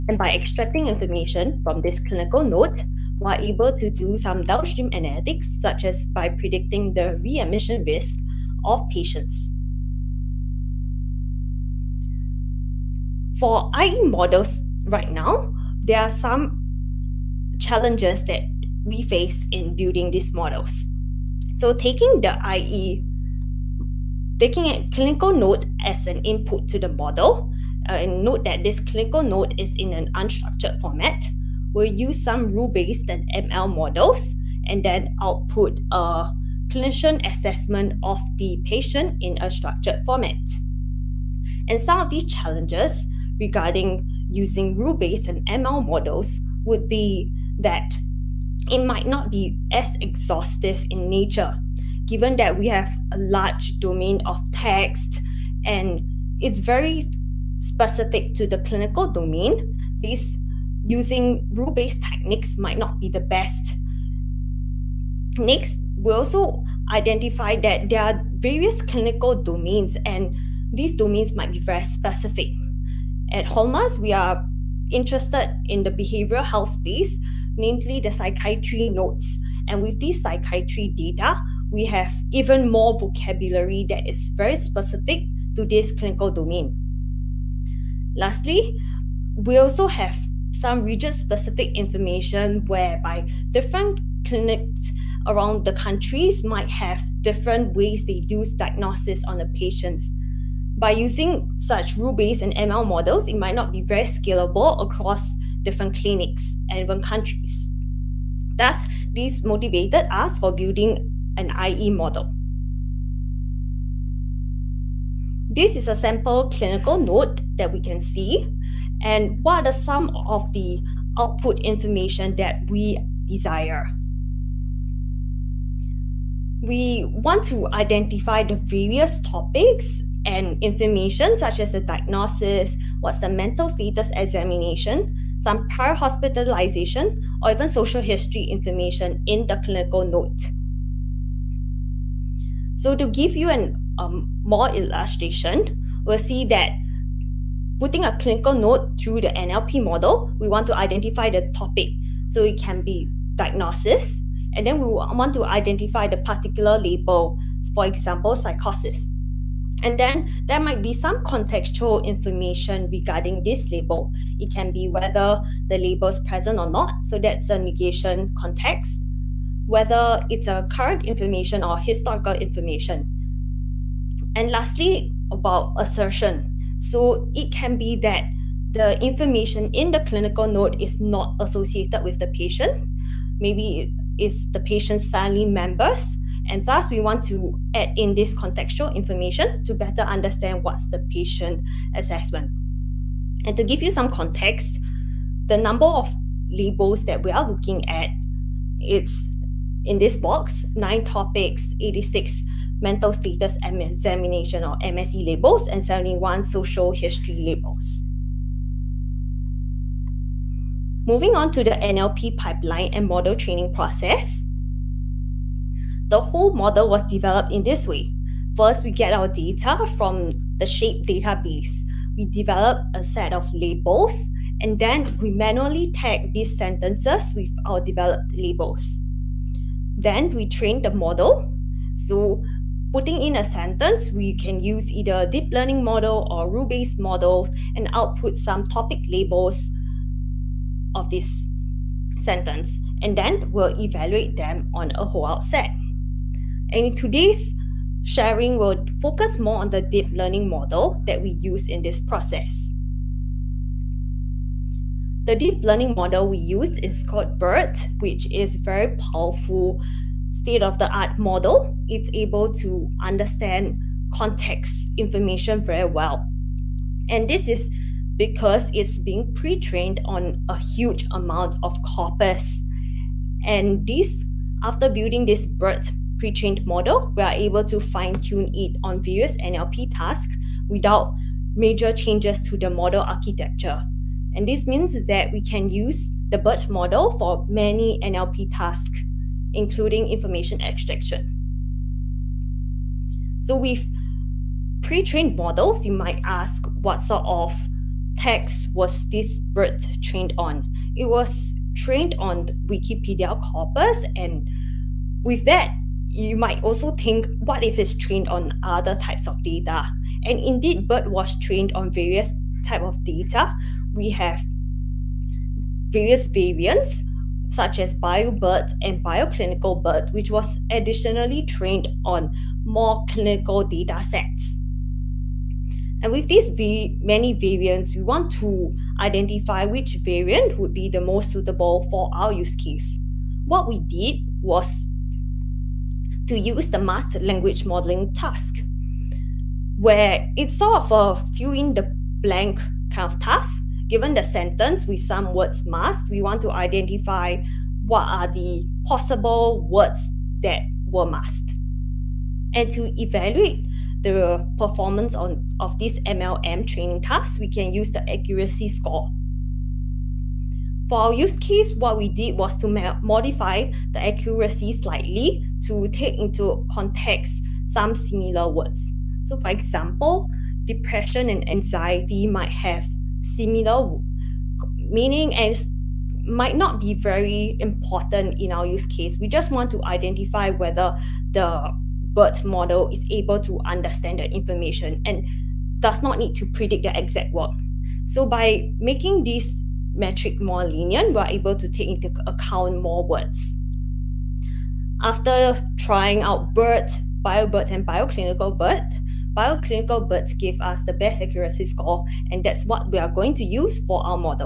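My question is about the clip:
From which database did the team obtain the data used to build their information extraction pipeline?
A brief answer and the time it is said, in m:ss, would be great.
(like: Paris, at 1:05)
SHAPE, at 3:40.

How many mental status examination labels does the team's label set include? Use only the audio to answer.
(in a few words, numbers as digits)
86.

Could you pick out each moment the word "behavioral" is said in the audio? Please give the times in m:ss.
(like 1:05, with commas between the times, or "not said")
1:15.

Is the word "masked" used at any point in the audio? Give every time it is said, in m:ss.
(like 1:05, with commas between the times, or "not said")
5:36, 5:45, 5:51.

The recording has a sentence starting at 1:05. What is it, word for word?
Next, we also identify that there are various clinical domains and these domains might be very specific.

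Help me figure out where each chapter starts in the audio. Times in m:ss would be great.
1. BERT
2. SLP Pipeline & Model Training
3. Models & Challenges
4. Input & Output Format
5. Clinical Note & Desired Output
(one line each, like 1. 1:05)
1. 4:13
2. 3:32
3. 0:12
4. 2:25
5. 1:54.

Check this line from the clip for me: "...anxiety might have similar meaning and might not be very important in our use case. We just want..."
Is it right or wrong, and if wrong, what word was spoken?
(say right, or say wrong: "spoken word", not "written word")
right.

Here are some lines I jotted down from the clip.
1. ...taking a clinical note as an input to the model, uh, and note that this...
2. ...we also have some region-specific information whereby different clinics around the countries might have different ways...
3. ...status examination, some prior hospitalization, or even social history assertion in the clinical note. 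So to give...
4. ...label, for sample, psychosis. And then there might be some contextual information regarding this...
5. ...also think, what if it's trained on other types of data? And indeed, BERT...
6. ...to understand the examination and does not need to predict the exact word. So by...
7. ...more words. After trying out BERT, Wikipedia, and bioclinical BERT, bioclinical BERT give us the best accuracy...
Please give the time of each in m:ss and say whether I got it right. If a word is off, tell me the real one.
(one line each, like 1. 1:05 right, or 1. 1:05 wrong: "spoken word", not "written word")
1. 0:24 right
2. 1:29 right
3. 2:13 wrong: "information", not "assertion"
4. 2:36 wrong: "example", not "sample"
5. 5:06 right
6. 6:23 wrong: "information", not "examination"
7. 6:32 wrong: "BioBERT", not "Wikipedia".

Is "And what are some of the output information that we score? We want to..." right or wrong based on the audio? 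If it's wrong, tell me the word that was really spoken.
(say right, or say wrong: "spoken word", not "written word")
wrong: "desire", not "score".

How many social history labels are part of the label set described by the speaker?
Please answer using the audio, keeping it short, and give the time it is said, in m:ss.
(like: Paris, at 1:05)
71, at 3:25.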